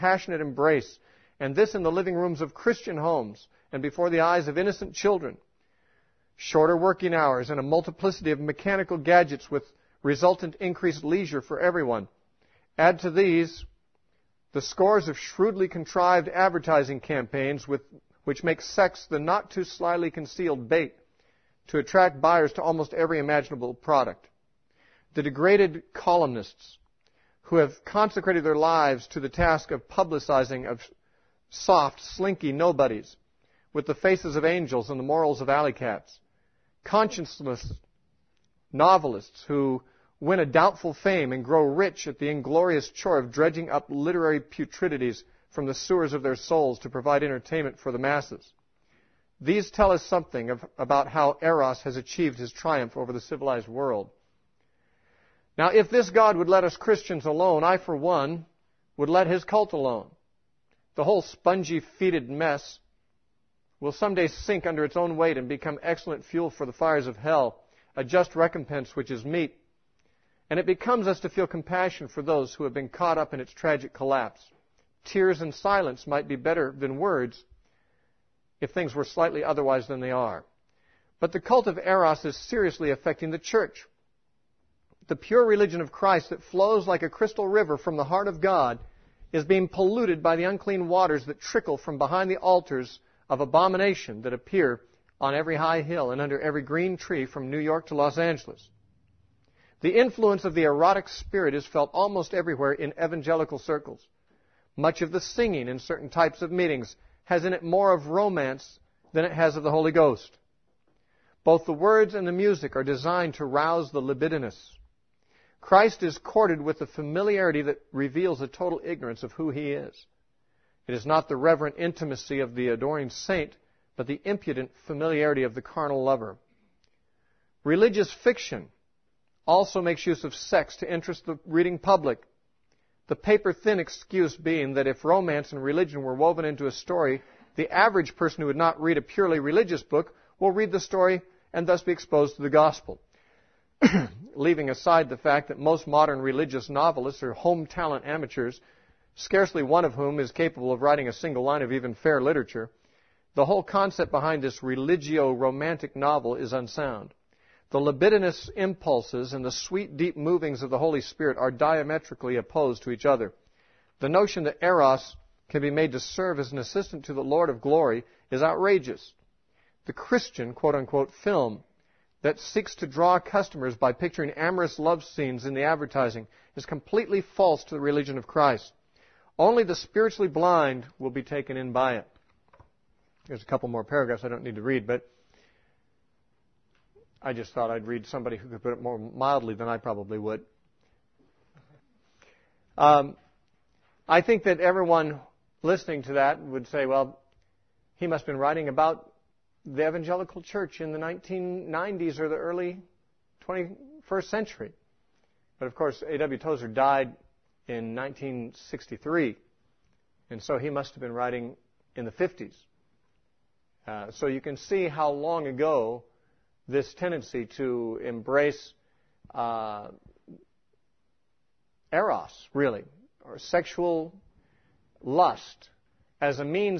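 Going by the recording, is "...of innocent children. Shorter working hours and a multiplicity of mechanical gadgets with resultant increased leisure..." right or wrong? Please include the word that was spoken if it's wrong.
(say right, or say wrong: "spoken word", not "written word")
right.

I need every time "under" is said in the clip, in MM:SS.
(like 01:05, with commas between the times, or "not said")
01:04, 01:36.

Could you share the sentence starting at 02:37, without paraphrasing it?
The libidinous impulses and the sweet, deep movings of the Holy Spirit are diametrically opposed to each other.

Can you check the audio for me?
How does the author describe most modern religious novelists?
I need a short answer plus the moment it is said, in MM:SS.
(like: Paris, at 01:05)
Home talent amateurs, at 02:27.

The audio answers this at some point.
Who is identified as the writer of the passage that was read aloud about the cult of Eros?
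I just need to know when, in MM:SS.
03:26.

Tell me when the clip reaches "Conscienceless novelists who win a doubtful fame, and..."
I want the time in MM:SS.
00:36.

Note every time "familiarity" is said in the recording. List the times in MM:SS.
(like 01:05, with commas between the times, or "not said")
01:56, 02:04.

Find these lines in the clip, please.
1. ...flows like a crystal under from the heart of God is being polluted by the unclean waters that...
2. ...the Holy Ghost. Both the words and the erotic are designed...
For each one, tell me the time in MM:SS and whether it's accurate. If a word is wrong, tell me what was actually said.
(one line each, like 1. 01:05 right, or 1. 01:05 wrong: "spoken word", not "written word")
1. 01:26 wrong: "river", not "under"
2. 01:49 wrong: "music", not "erotic".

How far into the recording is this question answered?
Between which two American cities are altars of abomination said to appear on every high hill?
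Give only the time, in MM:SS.
01:37.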